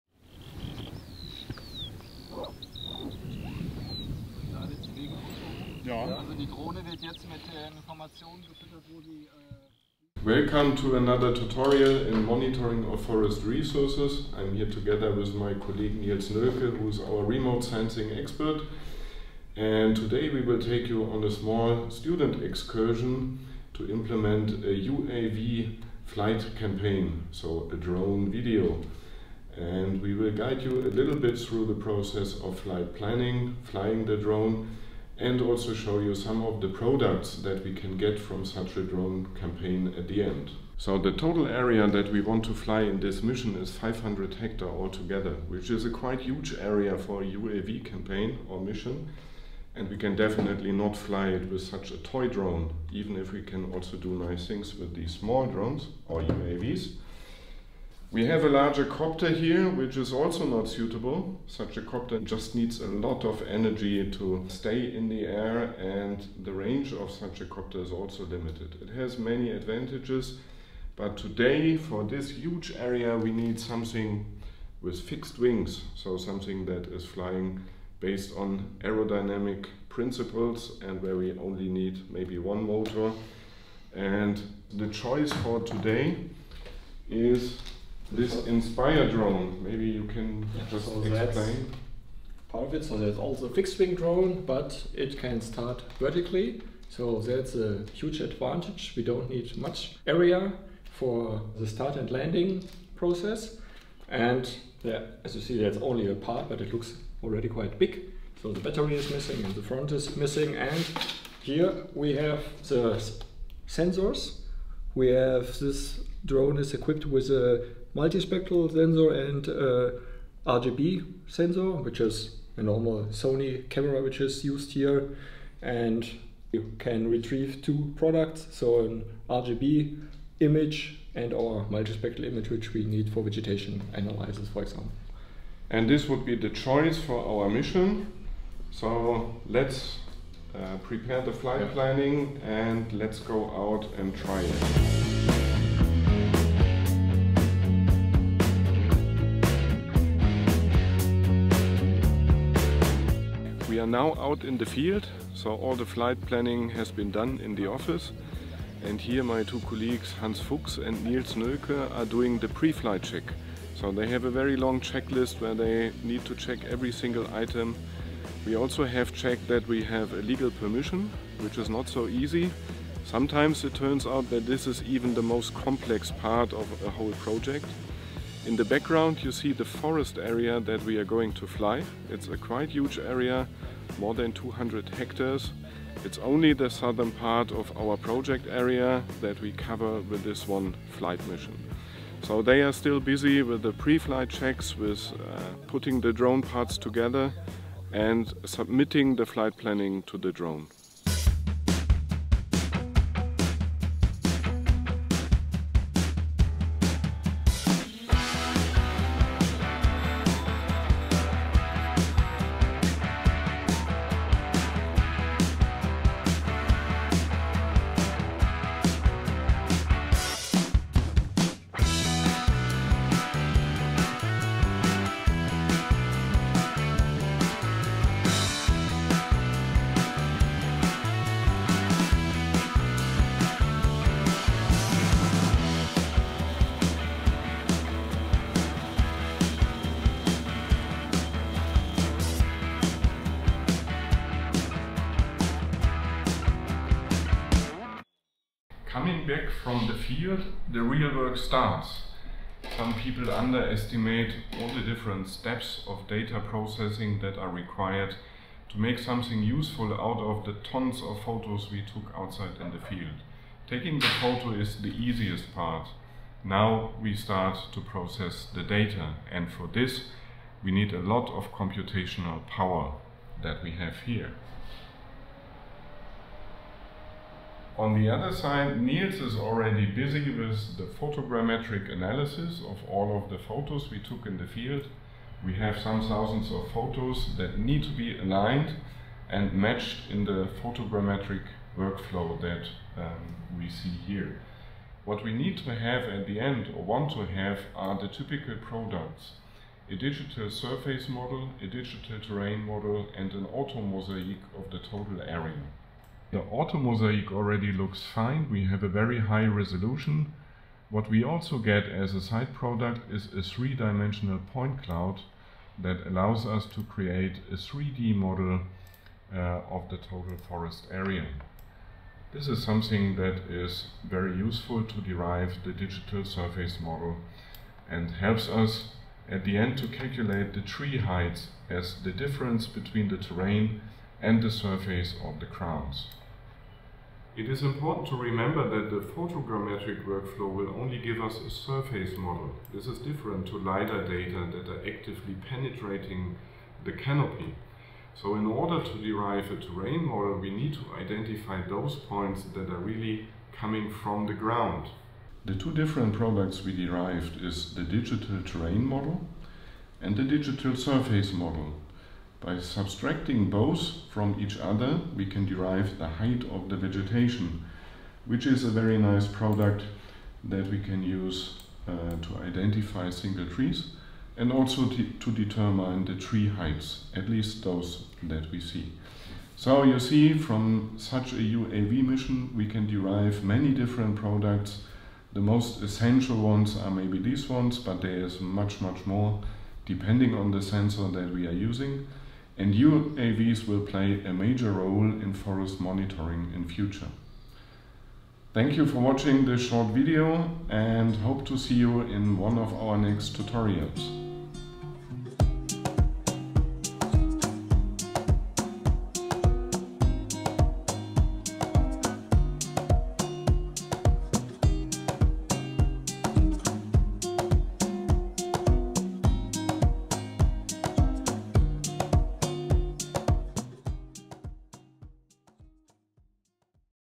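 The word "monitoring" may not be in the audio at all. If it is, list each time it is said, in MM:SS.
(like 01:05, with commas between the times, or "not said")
00:12, 06:35.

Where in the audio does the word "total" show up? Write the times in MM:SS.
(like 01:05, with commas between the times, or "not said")
00:41, 05:04, 05:19.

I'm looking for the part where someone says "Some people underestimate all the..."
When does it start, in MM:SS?
04:12.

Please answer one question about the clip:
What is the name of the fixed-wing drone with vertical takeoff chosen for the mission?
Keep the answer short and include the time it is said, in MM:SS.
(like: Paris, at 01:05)
Inspire, at 01:28.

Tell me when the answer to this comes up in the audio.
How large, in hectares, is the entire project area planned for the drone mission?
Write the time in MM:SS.
00:43.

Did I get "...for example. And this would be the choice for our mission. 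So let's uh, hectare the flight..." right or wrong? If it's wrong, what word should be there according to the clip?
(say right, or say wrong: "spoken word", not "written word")
wrong: "prepare", not "hectare".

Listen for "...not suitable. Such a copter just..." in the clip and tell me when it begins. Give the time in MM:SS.
01:00.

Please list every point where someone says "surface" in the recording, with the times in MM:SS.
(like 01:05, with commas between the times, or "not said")
05:00, 05:26, 05:34, 05:41, 06:00.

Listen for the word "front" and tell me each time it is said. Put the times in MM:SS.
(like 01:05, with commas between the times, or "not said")
01:49.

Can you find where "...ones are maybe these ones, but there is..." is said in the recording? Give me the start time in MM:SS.
06:26.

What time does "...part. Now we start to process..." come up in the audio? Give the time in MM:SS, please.
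04:25.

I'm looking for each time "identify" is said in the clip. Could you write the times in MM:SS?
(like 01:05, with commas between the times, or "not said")
05:50, 06:12.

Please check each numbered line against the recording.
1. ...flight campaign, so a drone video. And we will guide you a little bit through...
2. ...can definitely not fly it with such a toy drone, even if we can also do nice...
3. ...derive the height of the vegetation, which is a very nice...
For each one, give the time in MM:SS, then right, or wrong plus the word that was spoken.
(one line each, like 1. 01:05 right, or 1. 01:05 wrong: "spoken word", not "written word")
1. 00:26 right
2. 00:49 right
3. 06:05 right.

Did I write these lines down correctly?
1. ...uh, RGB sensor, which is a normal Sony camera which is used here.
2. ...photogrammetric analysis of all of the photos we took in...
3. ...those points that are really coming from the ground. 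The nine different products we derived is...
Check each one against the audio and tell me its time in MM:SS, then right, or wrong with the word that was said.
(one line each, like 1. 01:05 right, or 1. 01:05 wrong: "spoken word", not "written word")
1. 01:59 right
2. 04:40 right
3. 05:51 wrong: "two", not "nine".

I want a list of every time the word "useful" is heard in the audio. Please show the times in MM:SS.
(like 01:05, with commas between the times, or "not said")
04:19, 05:24.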